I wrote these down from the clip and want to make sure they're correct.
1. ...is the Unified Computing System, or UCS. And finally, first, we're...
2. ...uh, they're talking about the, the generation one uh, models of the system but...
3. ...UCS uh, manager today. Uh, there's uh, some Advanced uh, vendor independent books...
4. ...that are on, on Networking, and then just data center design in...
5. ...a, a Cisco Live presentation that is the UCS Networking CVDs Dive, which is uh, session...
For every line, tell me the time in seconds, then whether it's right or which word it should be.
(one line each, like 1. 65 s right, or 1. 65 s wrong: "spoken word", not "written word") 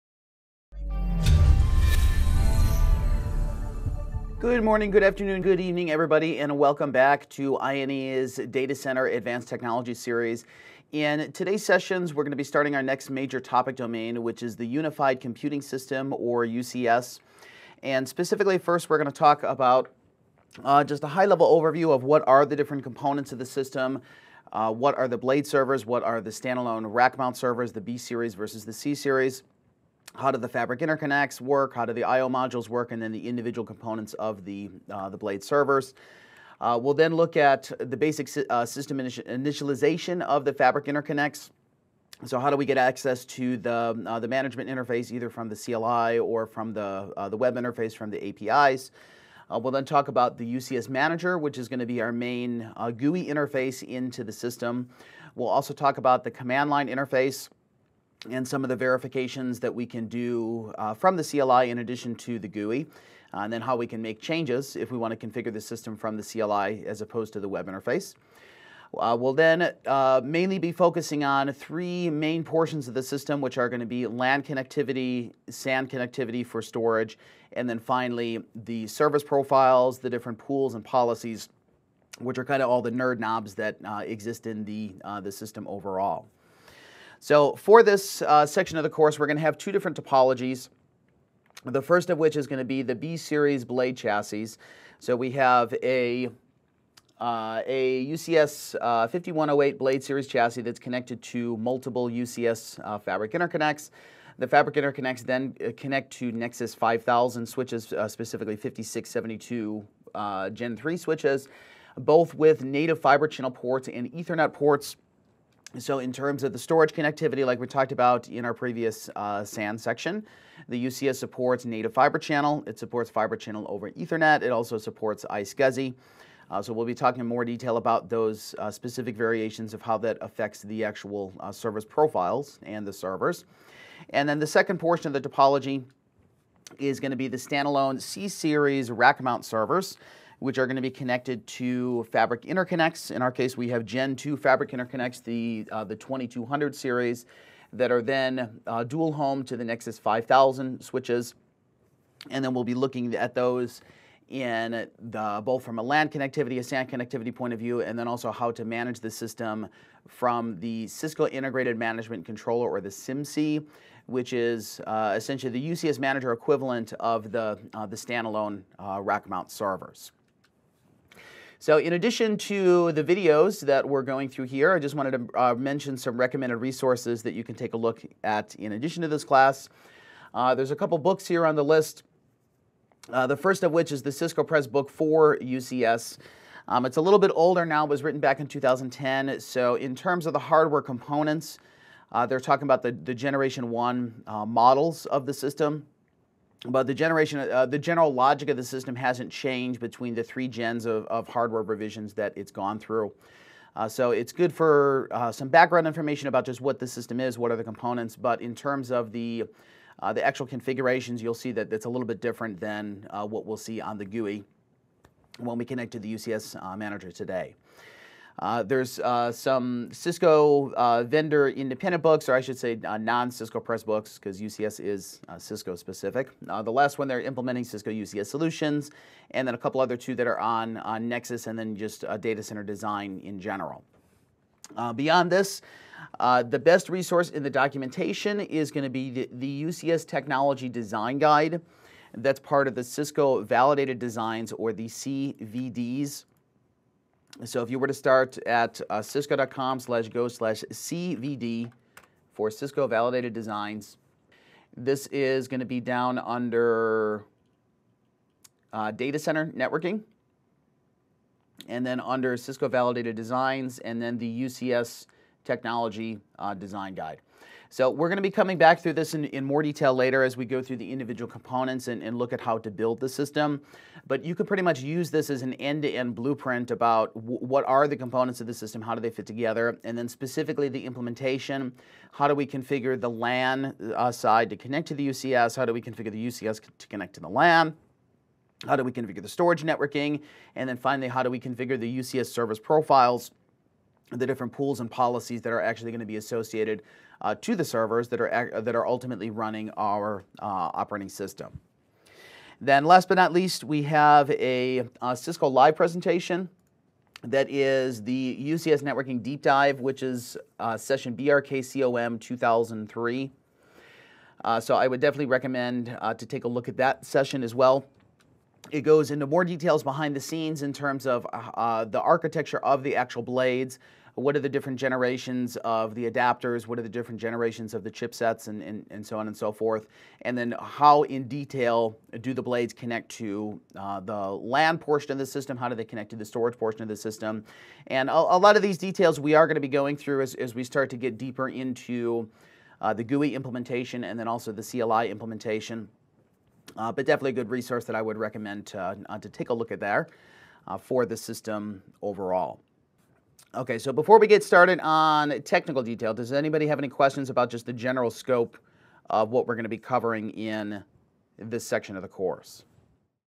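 1. 14 s wrong: "specifically", not "finally"
2. 192 s right
3. 216 s wrong: "Cisco", not "Advanced"
4. 230 s wrong: "Nexus", not "Networking"
5. 304 s wrong: "Deep", not "CVDs".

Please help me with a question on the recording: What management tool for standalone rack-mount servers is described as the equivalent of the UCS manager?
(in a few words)
Cisco Integrated Management Controller.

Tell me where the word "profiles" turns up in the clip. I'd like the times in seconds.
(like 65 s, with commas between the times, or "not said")
79 s, 131 s, 292 s.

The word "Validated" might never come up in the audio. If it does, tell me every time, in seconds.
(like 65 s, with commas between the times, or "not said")
243 s, 252 s, 262 s.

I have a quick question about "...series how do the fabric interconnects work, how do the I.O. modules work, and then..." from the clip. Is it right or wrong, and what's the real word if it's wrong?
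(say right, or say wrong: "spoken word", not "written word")
right.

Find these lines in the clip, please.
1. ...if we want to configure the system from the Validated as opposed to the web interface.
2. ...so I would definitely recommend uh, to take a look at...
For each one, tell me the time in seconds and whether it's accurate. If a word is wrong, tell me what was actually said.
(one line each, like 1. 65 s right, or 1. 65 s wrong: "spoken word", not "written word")
1. 64 s wrong: "CLI", not "Validated"
2. 314 s right.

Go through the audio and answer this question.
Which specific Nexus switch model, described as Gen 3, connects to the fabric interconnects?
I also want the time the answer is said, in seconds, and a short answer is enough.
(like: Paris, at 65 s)
5672, at 108 s.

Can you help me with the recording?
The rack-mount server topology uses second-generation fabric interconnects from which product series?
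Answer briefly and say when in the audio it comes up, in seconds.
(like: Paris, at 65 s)
2200 series, at 145 s.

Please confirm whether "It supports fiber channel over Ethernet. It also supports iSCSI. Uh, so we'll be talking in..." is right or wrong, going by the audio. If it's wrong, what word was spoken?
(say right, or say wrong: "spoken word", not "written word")
right.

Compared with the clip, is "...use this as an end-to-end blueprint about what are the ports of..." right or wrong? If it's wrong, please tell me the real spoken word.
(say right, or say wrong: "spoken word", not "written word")
wrong: "components", not "ports".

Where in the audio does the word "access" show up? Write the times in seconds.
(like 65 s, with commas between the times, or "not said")
42 s.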